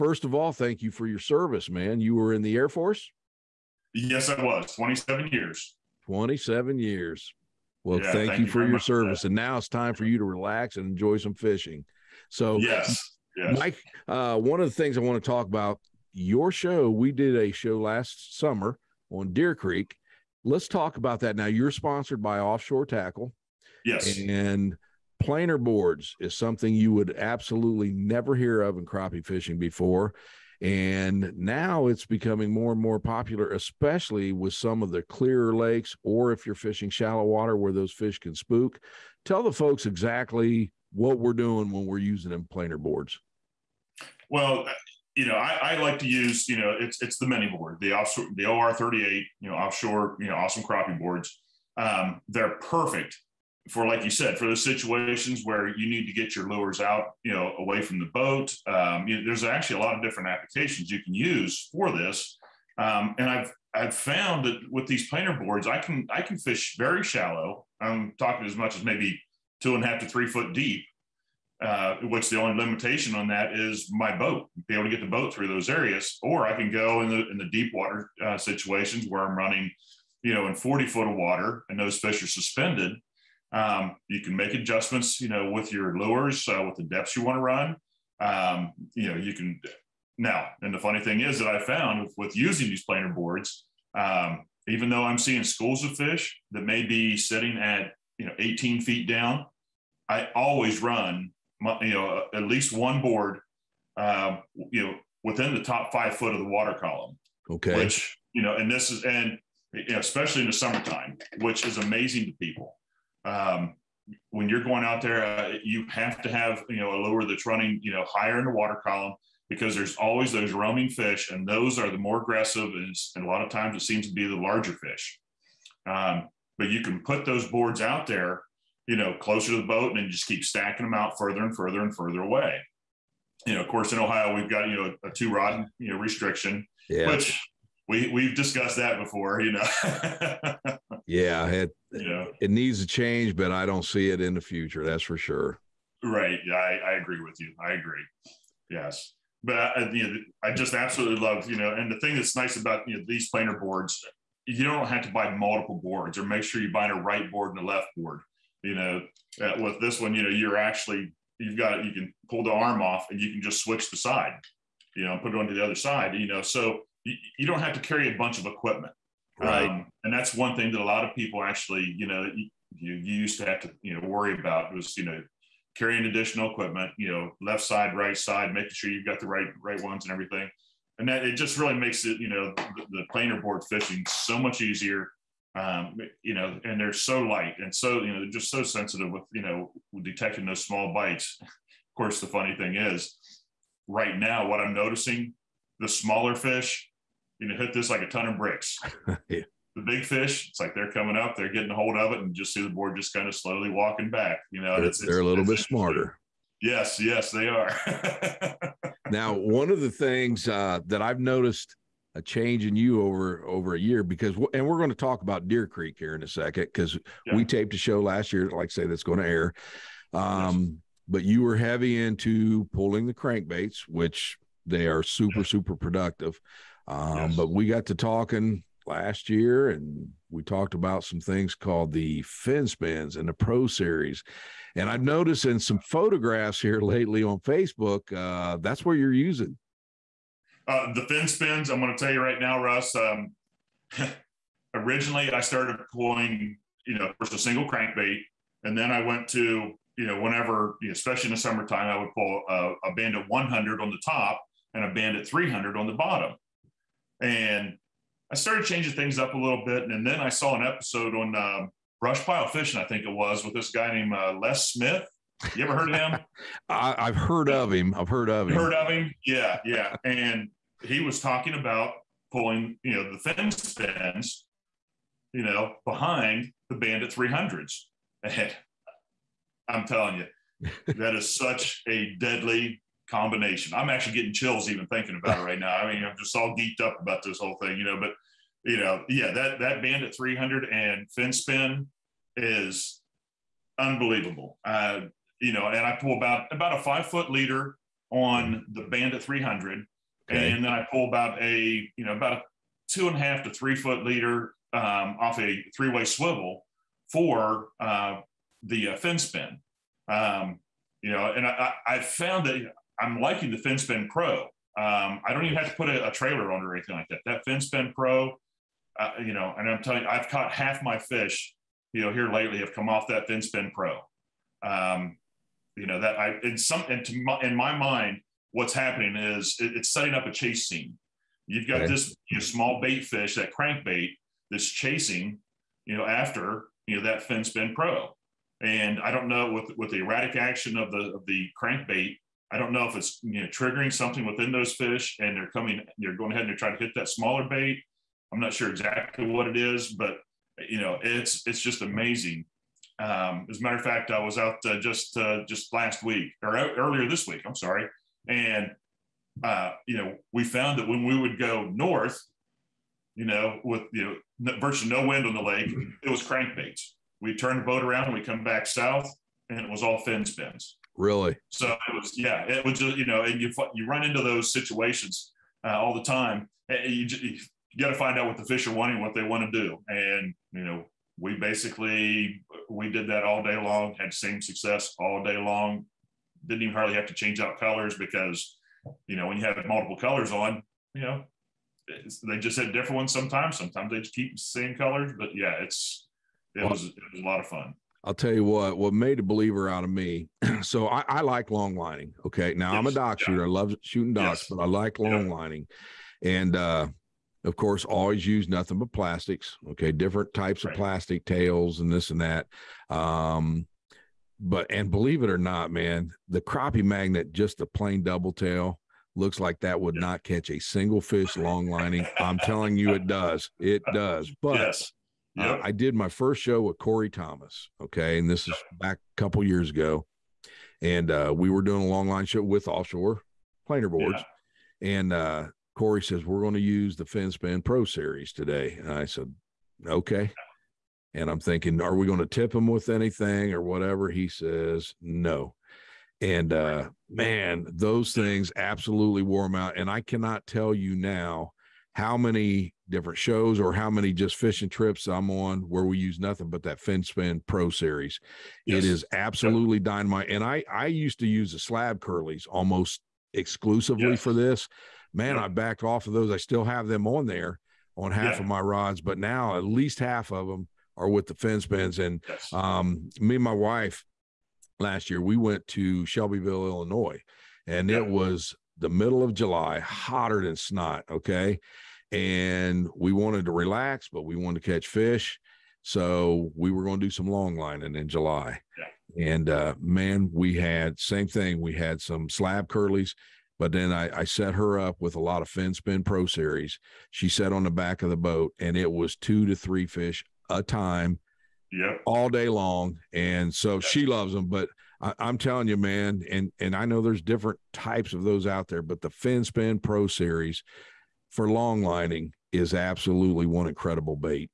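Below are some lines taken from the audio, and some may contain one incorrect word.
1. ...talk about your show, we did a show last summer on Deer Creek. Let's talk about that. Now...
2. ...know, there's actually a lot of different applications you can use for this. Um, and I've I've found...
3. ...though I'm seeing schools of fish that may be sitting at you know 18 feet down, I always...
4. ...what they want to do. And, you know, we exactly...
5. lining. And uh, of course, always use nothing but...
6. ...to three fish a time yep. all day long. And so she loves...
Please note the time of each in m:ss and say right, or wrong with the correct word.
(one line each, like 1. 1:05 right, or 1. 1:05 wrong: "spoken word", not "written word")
1. 0:15 right
2. 0:59 right
3. 1:34 right
4. 6:18 wrong: "basically", not "exactly"
5. 6:45 right
6. 8:19 right.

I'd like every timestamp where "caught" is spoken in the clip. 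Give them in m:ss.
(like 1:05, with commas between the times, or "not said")
5:20.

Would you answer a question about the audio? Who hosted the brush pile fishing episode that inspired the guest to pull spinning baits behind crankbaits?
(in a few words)
Les Smith.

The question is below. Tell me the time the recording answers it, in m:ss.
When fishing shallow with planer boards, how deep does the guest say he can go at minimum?
1:09.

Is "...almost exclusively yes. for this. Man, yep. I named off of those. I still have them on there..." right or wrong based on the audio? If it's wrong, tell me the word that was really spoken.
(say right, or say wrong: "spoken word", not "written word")
wrong: "backed", not "named".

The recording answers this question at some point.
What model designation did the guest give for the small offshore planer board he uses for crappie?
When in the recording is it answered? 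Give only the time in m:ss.
0:48.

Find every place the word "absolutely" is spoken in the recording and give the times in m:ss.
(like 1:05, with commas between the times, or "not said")
0:27, 2:30, 7:28, 7:39, 8:32.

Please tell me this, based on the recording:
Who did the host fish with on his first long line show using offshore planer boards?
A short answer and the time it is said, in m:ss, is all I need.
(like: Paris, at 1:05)
Corey Thomas, at 7:06.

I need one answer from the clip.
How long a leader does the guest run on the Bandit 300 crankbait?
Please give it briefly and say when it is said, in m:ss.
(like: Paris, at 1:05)
5 feet, at 4:56.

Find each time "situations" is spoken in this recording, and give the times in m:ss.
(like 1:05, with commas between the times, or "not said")
0:54, 1:18, 6:14.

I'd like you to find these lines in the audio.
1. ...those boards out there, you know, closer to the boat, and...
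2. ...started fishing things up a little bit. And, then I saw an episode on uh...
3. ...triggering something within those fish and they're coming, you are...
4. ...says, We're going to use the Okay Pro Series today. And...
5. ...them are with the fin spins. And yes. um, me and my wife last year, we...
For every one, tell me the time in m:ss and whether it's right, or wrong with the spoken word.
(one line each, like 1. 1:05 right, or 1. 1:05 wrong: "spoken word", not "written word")
1. 2:07 right
2. 4:18 wrong: "changing", not "fishing"
3. 5:43 right
4. 7:16 wrong: "FinSpin", not "Okay"
5. 7:50 right.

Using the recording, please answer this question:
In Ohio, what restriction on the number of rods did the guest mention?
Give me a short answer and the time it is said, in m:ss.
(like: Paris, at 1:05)
2 rod, at 2:15.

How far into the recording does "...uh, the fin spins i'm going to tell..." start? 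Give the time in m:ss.
4:00.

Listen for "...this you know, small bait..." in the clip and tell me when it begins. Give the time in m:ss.
5:31.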